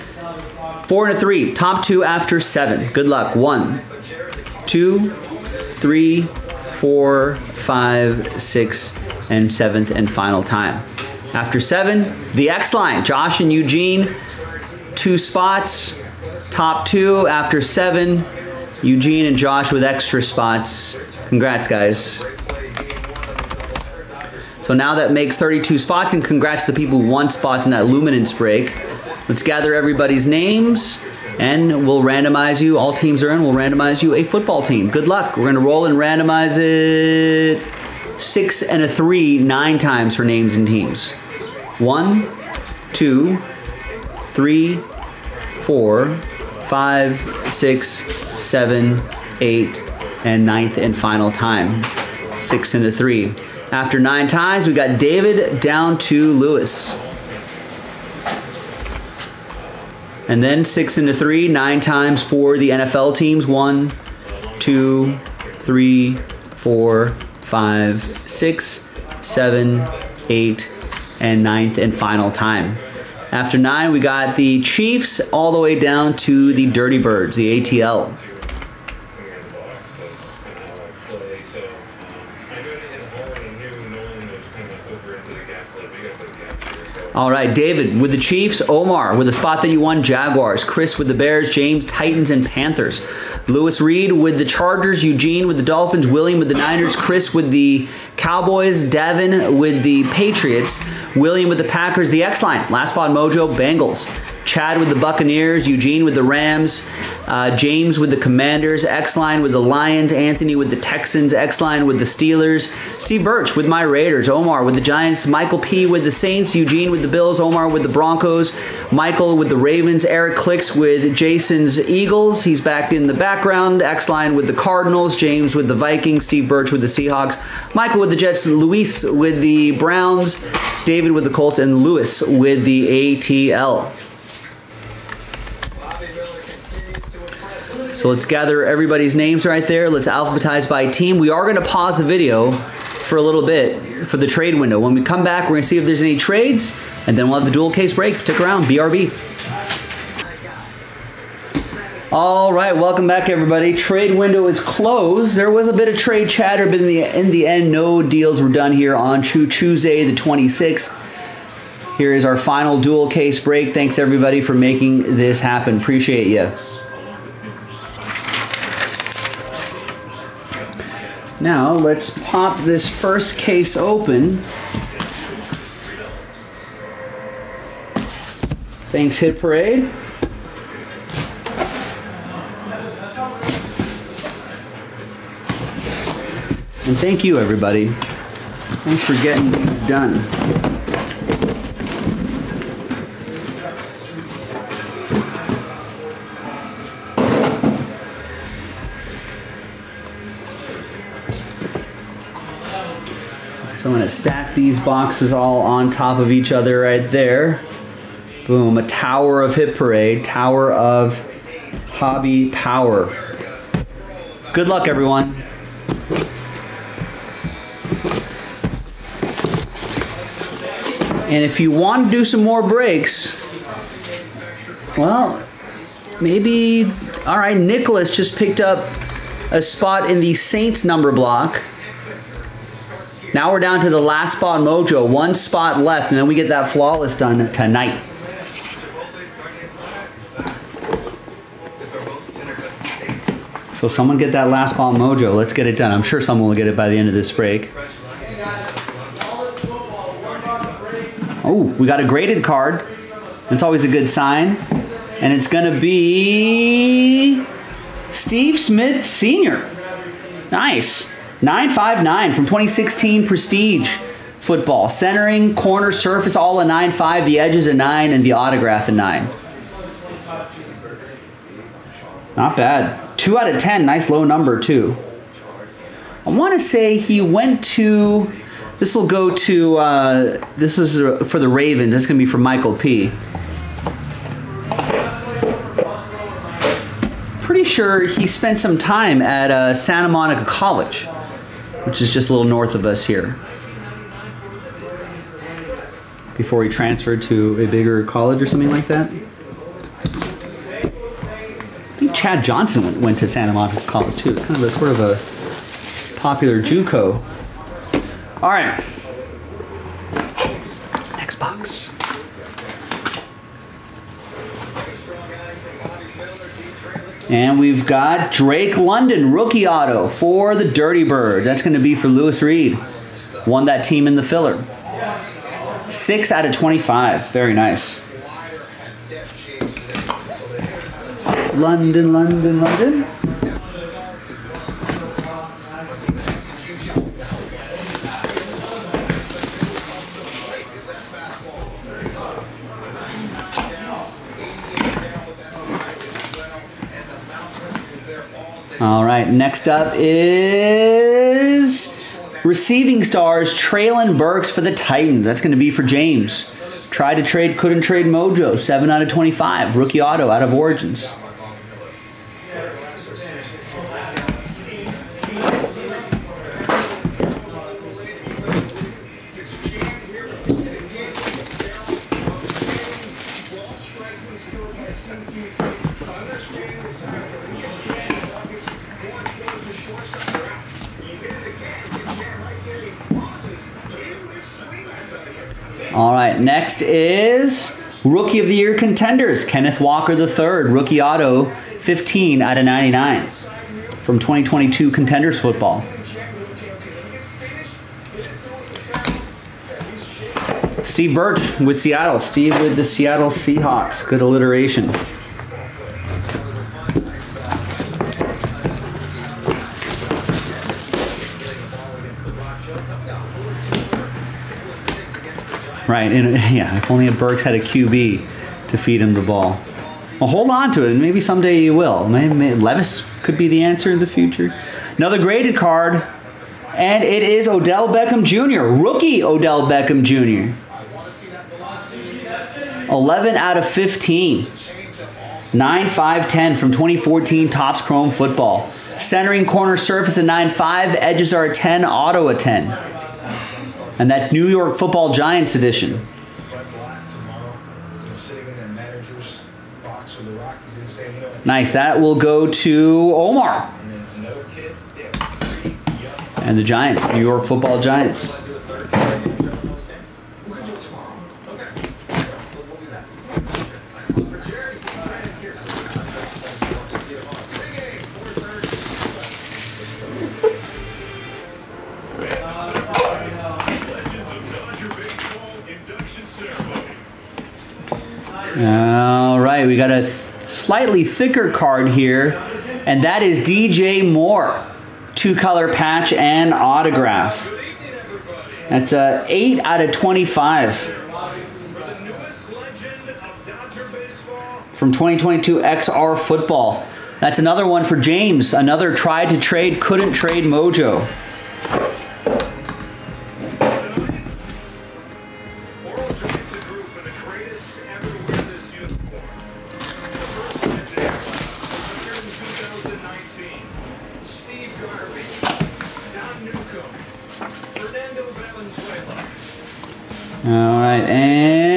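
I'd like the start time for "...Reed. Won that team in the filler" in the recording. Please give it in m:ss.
5:22.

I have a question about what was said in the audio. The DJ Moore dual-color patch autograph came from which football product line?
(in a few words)
XR Football.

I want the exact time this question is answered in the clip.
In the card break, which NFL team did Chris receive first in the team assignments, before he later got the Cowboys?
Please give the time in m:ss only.
1:30.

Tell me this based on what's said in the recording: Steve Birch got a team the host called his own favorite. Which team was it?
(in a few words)
Raiders.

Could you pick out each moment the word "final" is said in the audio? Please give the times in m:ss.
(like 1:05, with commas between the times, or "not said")
0:10, 0:50, 1:11, 2:42.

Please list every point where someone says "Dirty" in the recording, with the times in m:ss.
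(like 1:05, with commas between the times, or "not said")
1:16, 5:20.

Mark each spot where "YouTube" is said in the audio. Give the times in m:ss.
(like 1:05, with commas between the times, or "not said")
not said.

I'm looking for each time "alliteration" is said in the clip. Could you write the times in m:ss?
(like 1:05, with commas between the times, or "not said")
6:44.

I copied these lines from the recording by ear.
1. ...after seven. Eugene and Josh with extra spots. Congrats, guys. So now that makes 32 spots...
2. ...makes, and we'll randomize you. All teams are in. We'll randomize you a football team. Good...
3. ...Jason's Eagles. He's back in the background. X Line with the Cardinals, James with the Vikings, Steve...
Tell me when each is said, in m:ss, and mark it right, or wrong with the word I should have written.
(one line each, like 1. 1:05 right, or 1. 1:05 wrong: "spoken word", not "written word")
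1. 0:17 right
2. 0:30 wrong: "names", not "makes"
3. 2:01 right.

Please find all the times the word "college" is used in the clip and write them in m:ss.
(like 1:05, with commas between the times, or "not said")
4:50, 4:58, 5:03.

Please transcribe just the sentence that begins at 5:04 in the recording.
Kind of a sort of a popular JUCO.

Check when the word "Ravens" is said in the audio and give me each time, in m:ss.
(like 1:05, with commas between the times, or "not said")
1:59, 4:41.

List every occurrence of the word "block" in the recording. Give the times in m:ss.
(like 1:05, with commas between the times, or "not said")
3:51.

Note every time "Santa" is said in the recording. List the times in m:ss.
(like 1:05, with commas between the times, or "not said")
4:49, 5:03.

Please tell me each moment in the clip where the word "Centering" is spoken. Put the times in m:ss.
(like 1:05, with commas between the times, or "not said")
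4:24, 7:18.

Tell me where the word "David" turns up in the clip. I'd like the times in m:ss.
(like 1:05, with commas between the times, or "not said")
0:54, 1:27, 2:10.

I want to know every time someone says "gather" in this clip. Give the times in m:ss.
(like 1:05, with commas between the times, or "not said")
0:29, 2:18.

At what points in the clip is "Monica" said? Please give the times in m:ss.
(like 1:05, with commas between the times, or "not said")
4:50, 5:03.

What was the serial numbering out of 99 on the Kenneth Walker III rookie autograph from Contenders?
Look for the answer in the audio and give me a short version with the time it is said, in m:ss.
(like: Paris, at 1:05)
15, at 6:31.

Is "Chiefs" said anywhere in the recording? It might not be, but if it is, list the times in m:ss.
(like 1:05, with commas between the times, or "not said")
1:14, 1:28.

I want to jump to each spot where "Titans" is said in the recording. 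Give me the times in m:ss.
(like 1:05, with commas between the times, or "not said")
1:31, 5:54.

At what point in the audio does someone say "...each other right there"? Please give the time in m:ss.
3:26.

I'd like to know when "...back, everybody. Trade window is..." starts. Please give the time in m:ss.
2:33.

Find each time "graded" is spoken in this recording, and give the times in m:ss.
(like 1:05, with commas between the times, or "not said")
4:12, 7:05.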